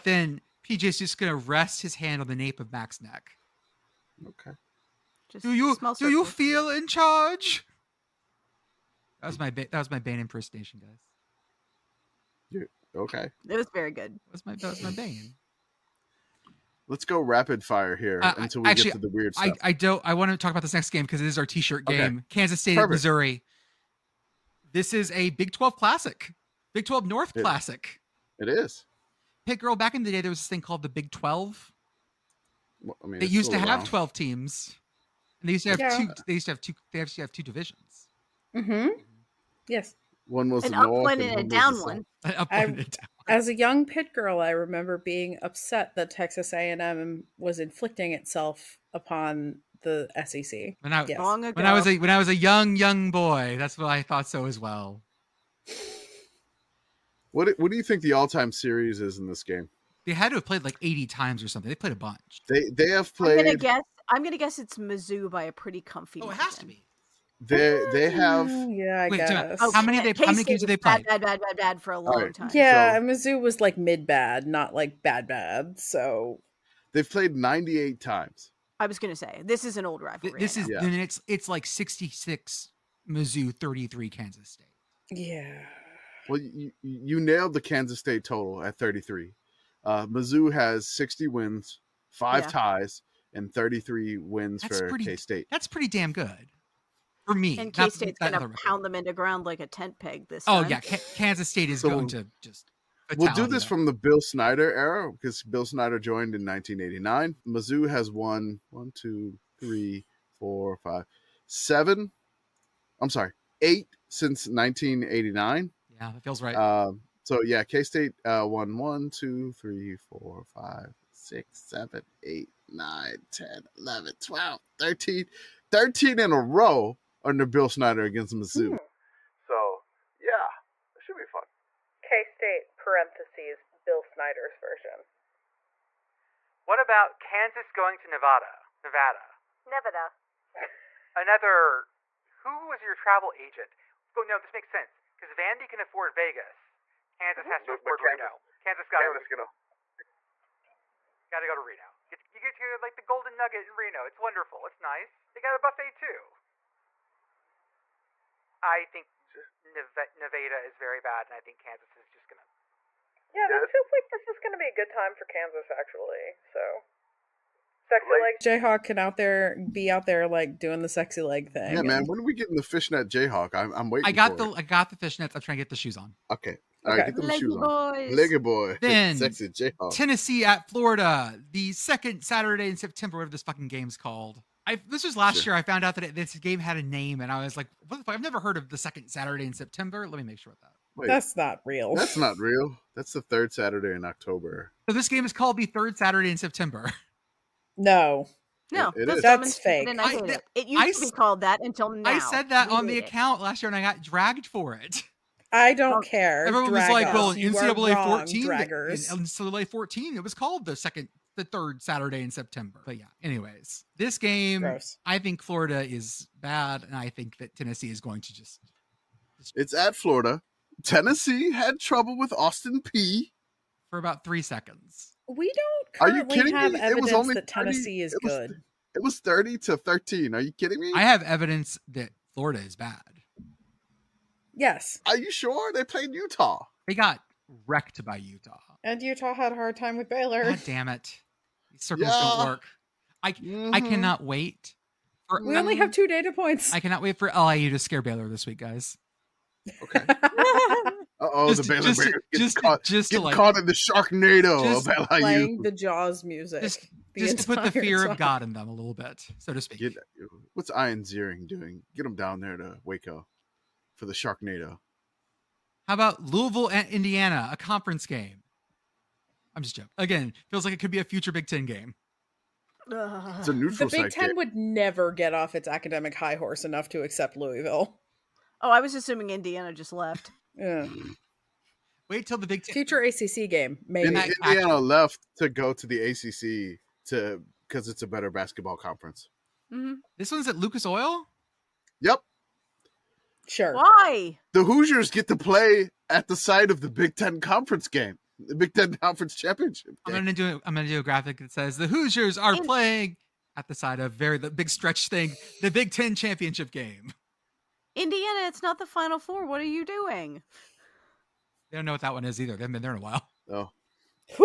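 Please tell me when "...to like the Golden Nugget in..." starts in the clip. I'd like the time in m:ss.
2:32.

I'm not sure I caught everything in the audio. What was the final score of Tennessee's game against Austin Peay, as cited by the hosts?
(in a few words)
30 to 13.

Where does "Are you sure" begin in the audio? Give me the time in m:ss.
3:55.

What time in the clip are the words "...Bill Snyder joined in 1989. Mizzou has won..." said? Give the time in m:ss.
1:45.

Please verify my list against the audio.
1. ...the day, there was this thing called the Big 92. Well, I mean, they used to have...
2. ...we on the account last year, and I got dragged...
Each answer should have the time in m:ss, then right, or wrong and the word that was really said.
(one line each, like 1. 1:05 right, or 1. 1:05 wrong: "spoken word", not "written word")
1. 0:30 wrong: "12", not "92"
2. 3:22 right.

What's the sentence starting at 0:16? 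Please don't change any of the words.
Let's go rapid fire here uh, until we actually, get to the weird stuff.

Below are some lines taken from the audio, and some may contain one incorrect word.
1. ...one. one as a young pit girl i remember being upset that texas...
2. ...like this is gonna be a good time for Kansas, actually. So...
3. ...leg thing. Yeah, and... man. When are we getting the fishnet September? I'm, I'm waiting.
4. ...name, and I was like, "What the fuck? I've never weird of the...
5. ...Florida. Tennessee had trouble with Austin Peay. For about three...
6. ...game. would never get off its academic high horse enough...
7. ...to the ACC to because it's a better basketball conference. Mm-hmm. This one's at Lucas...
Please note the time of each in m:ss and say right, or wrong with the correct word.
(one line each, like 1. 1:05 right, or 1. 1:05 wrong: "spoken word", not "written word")
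1. 0:41 right
2. 2:43 right
3. 2:51 wrong: "Jayhawk", not "September"
4. 3:06 wrong: "heard", not "weird"
5. 3:39 right
6. 4:34 right
7. 4:45 right.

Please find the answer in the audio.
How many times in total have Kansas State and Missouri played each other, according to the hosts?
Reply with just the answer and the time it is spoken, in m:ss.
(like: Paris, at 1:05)
98, at 1:17.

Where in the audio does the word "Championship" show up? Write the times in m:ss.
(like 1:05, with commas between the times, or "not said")
4:59, 5:06.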